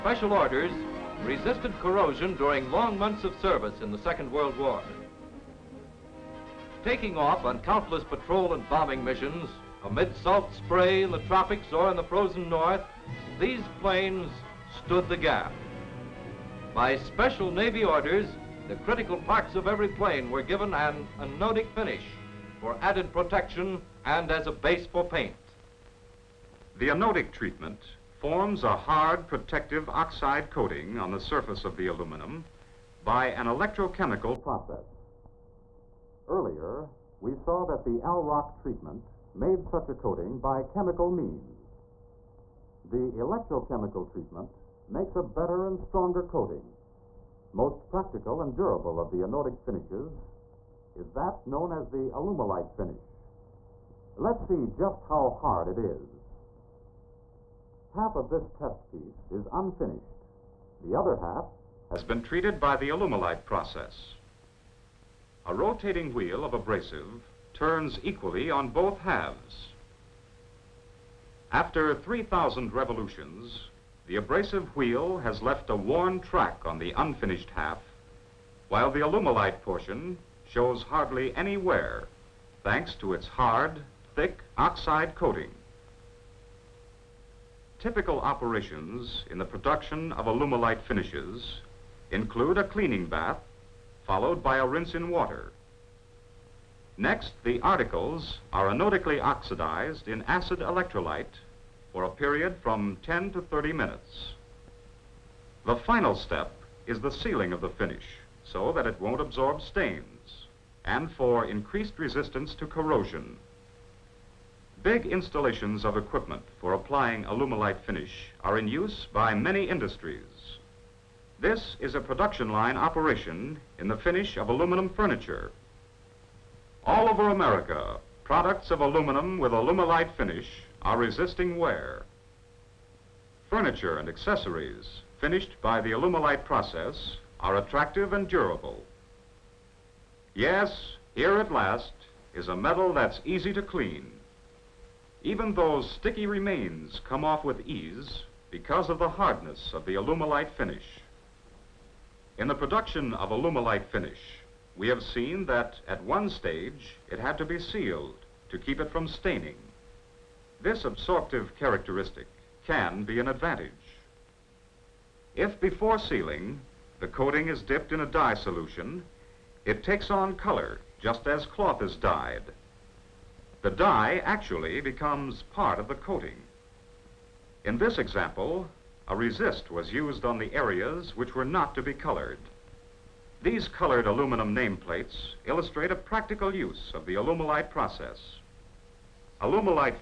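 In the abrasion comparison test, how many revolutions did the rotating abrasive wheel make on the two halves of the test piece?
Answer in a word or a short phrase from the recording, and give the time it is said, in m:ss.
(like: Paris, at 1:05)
3,000, at 1:11.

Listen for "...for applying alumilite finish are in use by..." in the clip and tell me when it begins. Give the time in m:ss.
1:56.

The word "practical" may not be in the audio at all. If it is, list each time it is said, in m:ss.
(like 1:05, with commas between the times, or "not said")
0:47, 3:05.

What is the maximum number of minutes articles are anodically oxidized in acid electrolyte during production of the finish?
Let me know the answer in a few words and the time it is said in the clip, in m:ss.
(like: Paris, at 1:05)
30, at 1:43.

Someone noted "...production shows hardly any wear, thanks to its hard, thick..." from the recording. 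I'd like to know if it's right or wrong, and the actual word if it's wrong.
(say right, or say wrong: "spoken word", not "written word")
wrong: "portion", not "production".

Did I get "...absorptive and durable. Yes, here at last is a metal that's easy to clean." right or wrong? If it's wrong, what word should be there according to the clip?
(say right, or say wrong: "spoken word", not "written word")
wrong: "attractive", not "absorptive".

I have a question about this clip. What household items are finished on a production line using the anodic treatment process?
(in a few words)
aluminum furniture.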